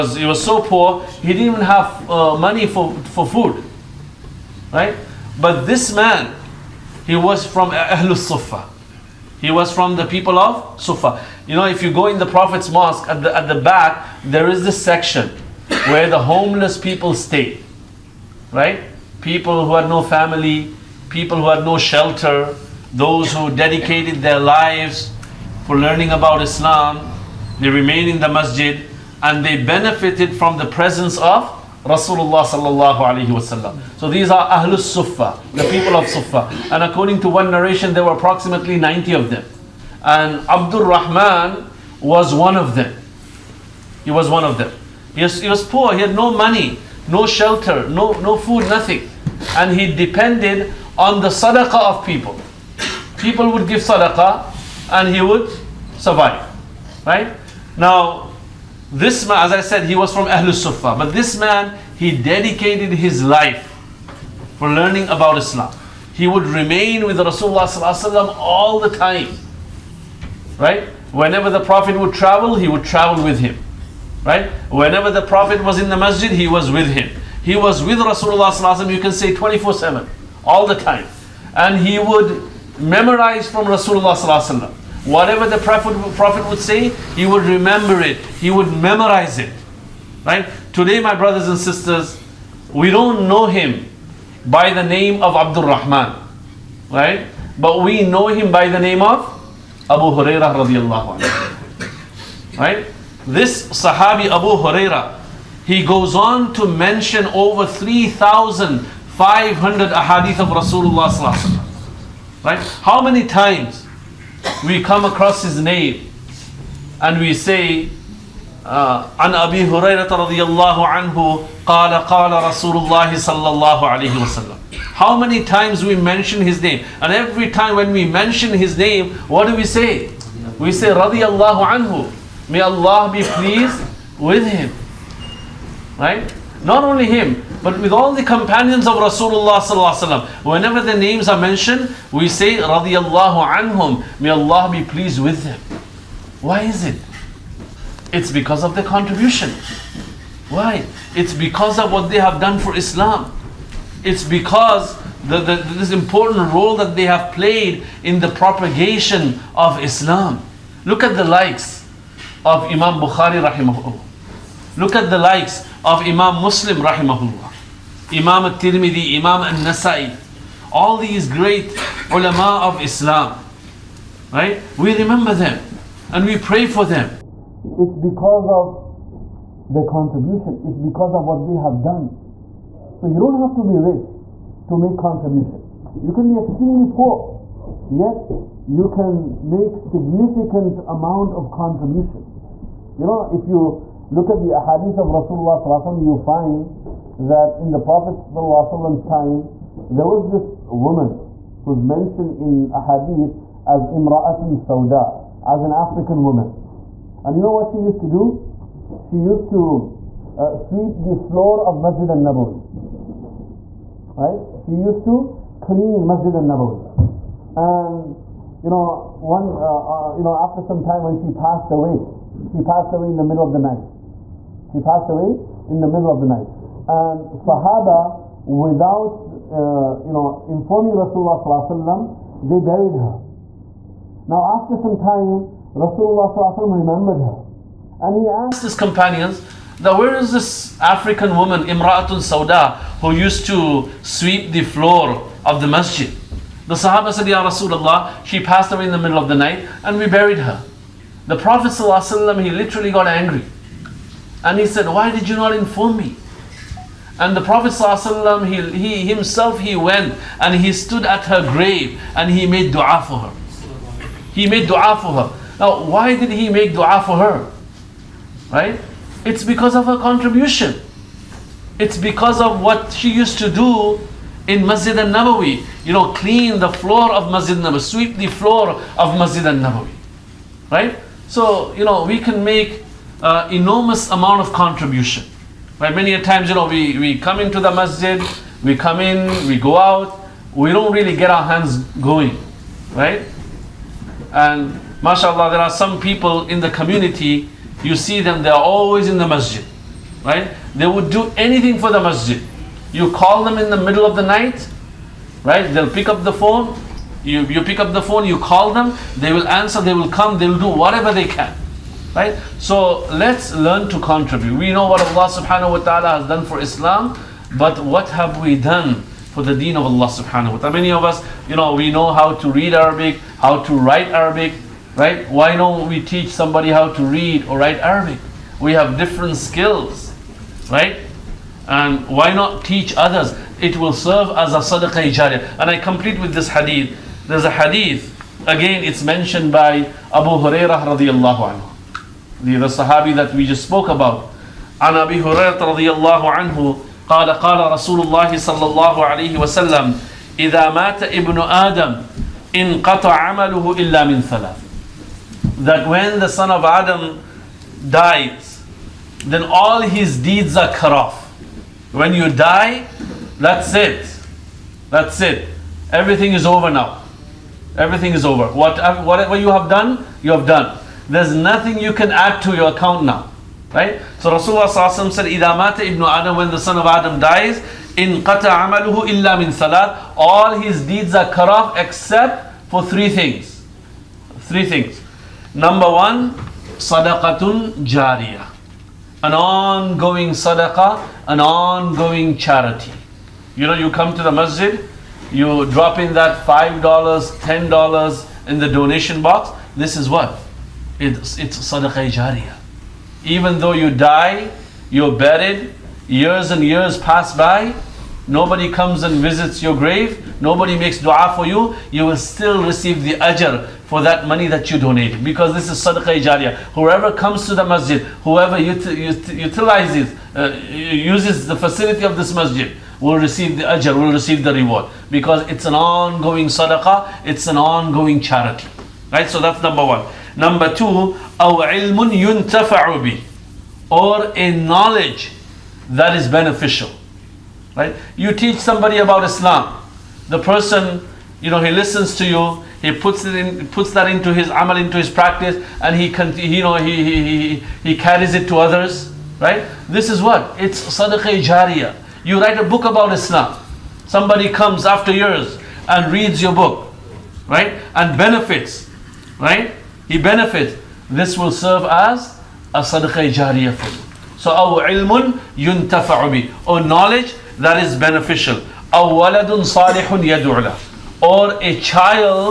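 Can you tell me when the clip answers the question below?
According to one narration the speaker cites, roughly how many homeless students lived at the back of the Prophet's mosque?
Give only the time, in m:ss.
0:38.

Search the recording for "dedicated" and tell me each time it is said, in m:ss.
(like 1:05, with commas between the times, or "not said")
0:23, 1:02.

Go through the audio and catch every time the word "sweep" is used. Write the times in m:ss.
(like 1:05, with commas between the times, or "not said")
3:30, 4:04, 4:37.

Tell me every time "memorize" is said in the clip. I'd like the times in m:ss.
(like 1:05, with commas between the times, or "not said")
1:22, 1:28.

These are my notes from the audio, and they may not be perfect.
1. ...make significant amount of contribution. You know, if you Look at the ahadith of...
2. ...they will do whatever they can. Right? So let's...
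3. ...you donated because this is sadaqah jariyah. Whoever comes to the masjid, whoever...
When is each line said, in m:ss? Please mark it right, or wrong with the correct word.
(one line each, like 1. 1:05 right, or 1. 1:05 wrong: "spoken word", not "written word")
1. 3:09 right
2. 5:10 right
3. 6:54 right.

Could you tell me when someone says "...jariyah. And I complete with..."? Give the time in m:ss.
5:35.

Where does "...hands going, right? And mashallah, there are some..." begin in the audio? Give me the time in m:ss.
4:51.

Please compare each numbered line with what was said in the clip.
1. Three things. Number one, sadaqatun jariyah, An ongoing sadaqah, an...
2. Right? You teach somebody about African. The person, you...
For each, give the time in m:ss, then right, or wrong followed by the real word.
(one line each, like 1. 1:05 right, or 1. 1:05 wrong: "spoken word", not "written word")
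1. 6:24 right
2. 7:17 wrong: "Islam", not "African".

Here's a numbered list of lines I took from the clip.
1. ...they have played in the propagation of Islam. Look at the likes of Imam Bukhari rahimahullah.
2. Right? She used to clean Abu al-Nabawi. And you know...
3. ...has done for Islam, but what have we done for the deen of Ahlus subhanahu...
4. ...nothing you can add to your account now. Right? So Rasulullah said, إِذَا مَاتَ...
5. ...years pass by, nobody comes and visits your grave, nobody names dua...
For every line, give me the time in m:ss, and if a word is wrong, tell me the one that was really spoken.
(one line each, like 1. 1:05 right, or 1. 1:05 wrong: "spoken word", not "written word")
1. 2:36 right
2. 3:34 wrong: "Masjid", not "Abu"
3. 5:16 wrong: "Allah", not "Ahlus"
4. 6:11 right
5. 6:46 wrong: "makes", not "names".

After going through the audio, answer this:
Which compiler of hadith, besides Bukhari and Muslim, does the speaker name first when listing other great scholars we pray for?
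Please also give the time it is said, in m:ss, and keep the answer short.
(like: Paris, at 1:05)
Imam al-Tirmidhi, at 2:48.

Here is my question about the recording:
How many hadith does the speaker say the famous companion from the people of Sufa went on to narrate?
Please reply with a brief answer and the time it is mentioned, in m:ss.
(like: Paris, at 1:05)
over 3,500, at 1:47.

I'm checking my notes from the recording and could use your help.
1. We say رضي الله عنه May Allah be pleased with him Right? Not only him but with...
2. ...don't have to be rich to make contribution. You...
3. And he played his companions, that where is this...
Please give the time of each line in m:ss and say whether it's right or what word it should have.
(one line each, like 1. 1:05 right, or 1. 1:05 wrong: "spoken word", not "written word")
1. 2:10 right
2. 3:03 right
3. 3:58 wrong: "asked", not "played".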